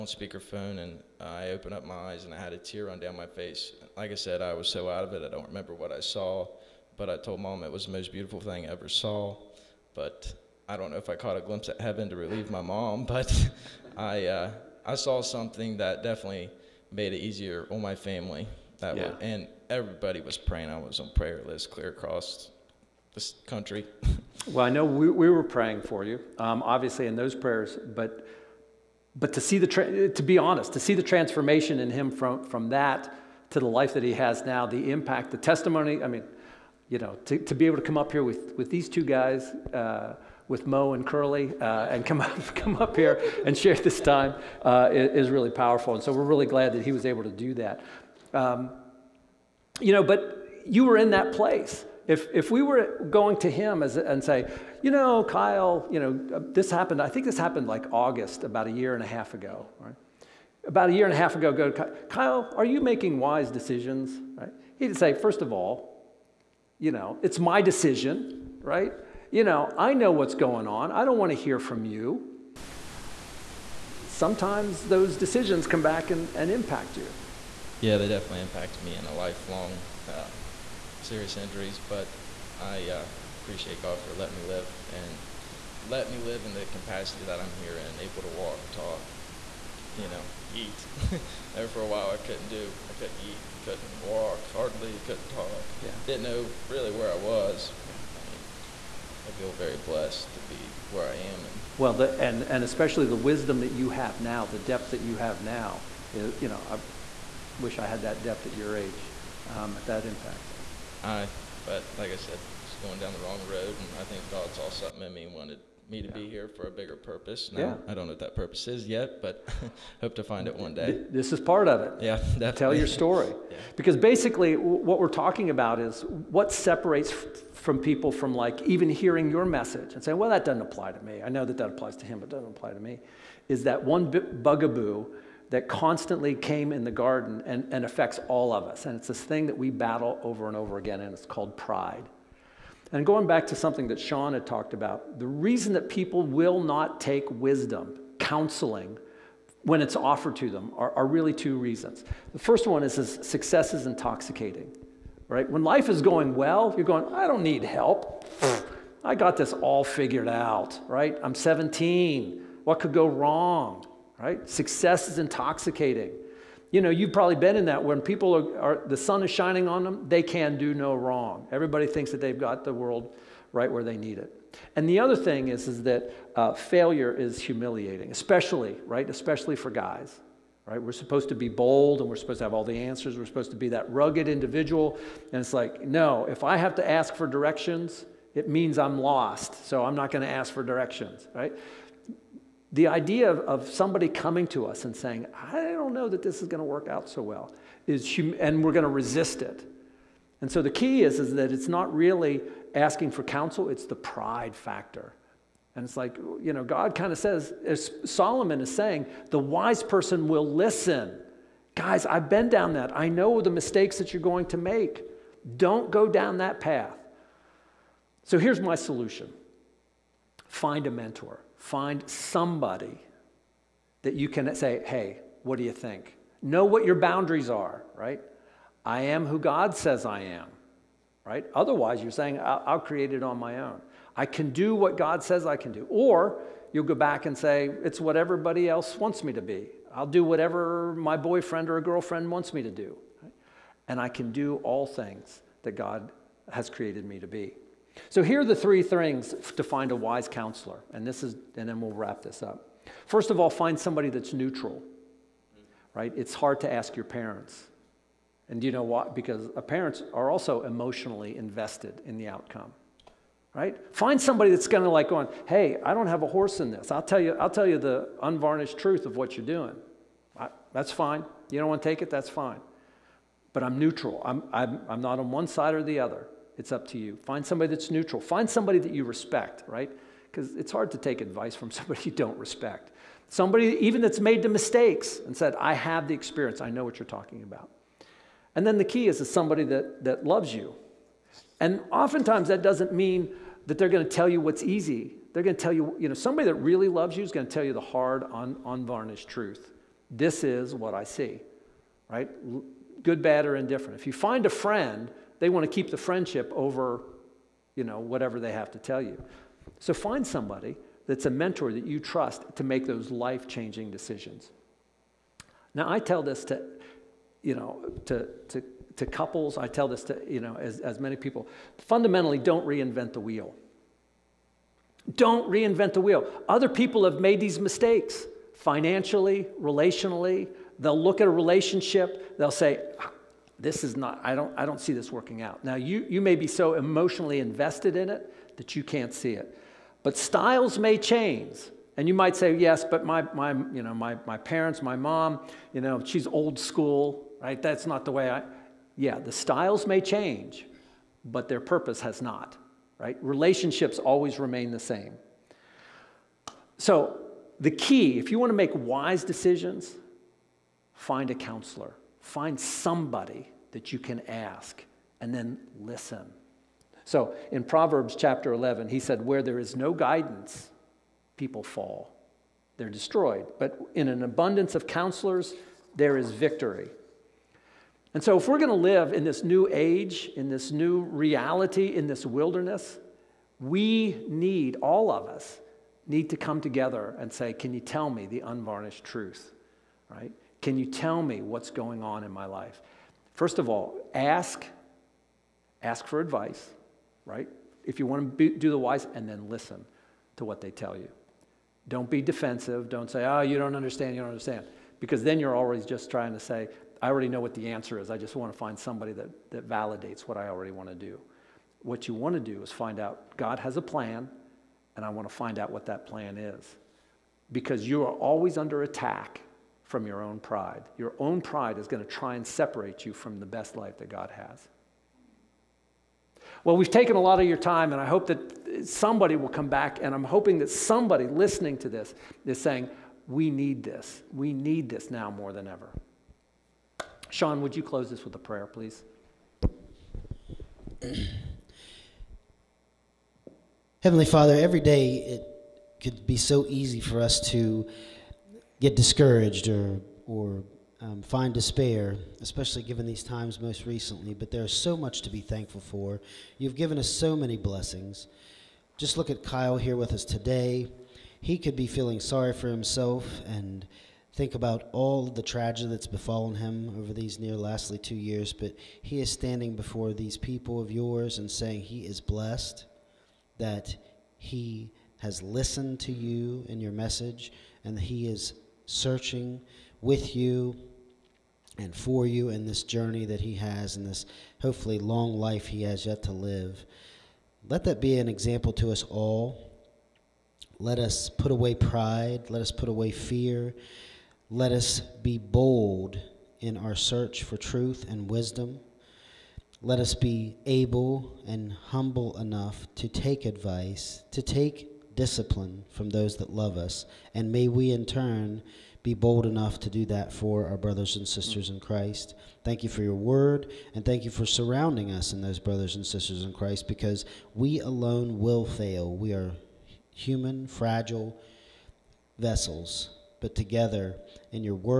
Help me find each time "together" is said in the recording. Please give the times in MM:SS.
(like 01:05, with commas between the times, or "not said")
06:26, 08:43.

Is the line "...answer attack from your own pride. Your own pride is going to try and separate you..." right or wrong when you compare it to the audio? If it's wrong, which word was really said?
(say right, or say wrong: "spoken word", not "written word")
wrong: "under", not "answer".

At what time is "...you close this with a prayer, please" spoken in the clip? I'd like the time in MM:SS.
07:17.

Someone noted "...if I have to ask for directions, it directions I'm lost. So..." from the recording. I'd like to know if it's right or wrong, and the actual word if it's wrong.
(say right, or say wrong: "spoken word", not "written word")
wrong: "means", not "directions".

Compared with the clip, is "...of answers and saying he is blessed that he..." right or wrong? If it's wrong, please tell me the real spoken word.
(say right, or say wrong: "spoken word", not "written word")
wrong: "yours", not "answers".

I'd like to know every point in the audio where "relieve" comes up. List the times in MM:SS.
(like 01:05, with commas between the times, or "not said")
00:12.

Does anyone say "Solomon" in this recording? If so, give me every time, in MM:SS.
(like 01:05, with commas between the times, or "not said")
03:28.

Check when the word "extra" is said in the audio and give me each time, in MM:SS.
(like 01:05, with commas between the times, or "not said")
not said.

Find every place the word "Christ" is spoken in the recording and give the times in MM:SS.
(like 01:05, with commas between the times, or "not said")
08:31, 08:36.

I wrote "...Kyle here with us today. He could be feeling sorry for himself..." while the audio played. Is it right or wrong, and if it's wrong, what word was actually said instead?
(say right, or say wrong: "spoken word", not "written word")
right.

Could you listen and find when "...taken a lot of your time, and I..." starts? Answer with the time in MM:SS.
07:06.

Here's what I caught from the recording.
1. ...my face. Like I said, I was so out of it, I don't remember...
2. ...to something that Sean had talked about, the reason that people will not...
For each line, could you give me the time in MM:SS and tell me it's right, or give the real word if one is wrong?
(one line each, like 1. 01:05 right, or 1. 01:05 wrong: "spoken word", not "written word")
1. 00:03 right
2. 02:23 right.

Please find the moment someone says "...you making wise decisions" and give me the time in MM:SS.
01:02.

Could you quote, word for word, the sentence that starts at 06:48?
I just want to find somebody that, that validates what I already want to do.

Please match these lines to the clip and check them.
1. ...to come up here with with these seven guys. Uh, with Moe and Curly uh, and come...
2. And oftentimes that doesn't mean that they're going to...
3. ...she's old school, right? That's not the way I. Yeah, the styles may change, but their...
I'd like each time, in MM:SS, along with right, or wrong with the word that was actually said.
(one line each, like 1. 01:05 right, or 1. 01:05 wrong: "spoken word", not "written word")
1. 00:37 wrong: "two", not "seven"
2. 04:51 right
3. 05:46 right.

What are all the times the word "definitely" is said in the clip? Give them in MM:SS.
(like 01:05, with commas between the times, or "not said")
00:16, 01:18, 02:02.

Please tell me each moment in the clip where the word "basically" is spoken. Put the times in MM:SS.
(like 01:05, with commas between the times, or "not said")
02:03.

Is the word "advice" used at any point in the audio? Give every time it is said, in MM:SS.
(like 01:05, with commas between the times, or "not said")
04:41, 06:36, 08:23.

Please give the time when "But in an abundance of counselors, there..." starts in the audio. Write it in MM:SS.
06:13.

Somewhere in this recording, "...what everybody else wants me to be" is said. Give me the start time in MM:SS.
03:57.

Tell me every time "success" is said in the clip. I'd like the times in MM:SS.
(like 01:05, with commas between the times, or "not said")
02:33, 02:44.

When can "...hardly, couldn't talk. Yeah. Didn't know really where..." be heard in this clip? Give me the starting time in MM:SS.
01:34.